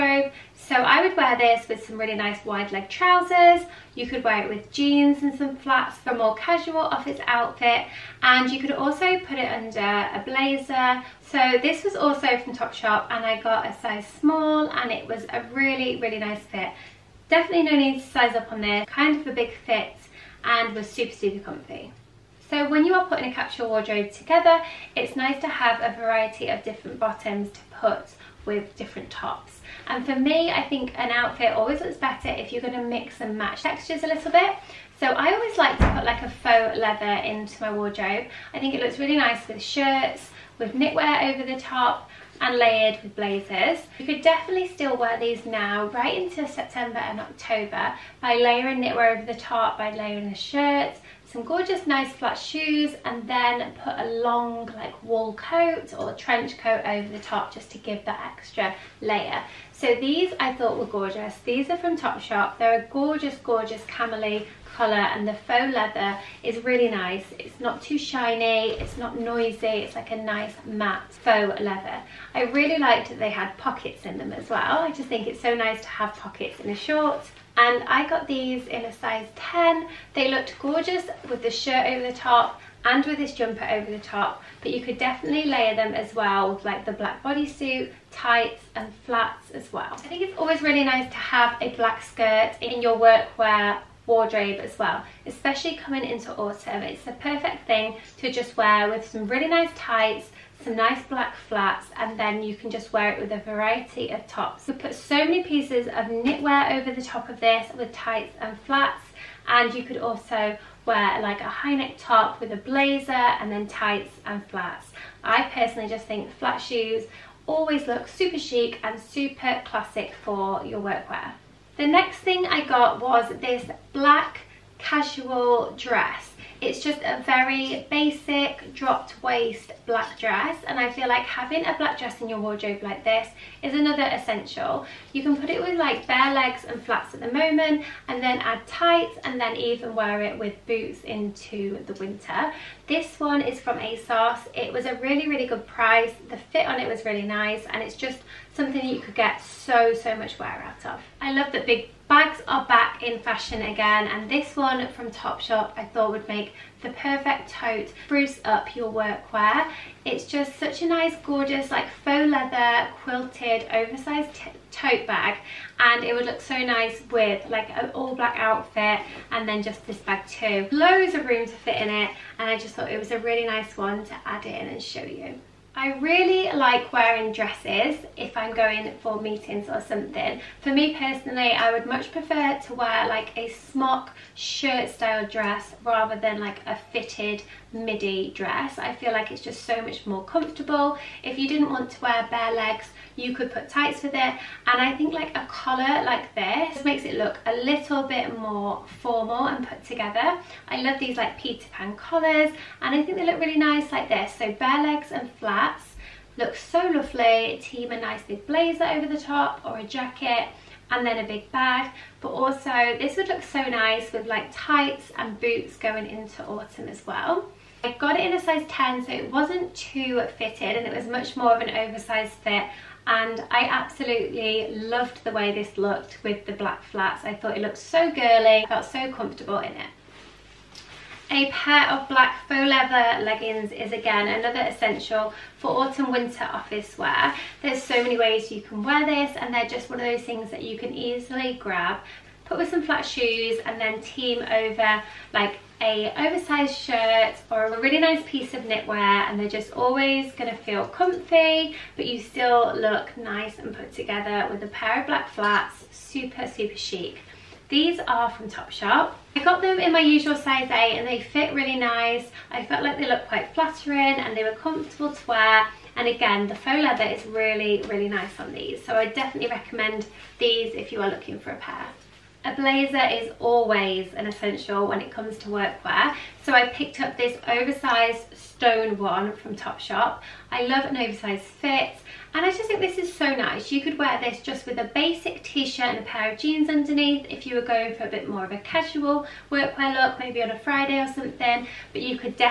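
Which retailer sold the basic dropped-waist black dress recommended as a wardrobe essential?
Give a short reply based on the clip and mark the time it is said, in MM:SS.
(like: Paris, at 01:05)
ASOS, at 02:23.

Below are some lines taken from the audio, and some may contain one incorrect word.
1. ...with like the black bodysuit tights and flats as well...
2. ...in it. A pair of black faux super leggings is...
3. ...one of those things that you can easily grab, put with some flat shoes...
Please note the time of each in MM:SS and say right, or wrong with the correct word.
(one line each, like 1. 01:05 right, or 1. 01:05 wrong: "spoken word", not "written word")
1. 01:26 right
2. 03:49 wrong: "leather", not "super"
3. 03:59 right.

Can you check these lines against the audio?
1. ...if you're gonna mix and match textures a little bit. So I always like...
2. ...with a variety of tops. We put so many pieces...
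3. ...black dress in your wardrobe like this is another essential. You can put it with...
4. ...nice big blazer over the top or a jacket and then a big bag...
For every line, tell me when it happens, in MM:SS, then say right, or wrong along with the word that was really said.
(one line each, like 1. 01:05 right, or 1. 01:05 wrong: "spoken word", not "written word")
1. 00:32 right
2. 01:43 right
3. 02:11 right
4. 03:27 right.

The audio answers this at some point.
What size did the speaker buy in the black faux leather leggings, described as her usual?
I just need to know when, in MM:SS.
04:20.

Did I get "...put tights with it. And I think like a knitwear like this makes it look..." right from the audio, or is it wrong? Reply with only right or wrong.
wrong.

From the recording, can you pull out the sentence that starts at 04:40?
I love an oversized fit and I just think this is so nice.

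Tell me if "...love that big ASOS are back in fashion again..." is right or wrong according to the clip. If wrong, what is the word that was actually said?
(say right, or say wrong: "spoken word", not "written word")
wrong: "Bags", not "ASOS".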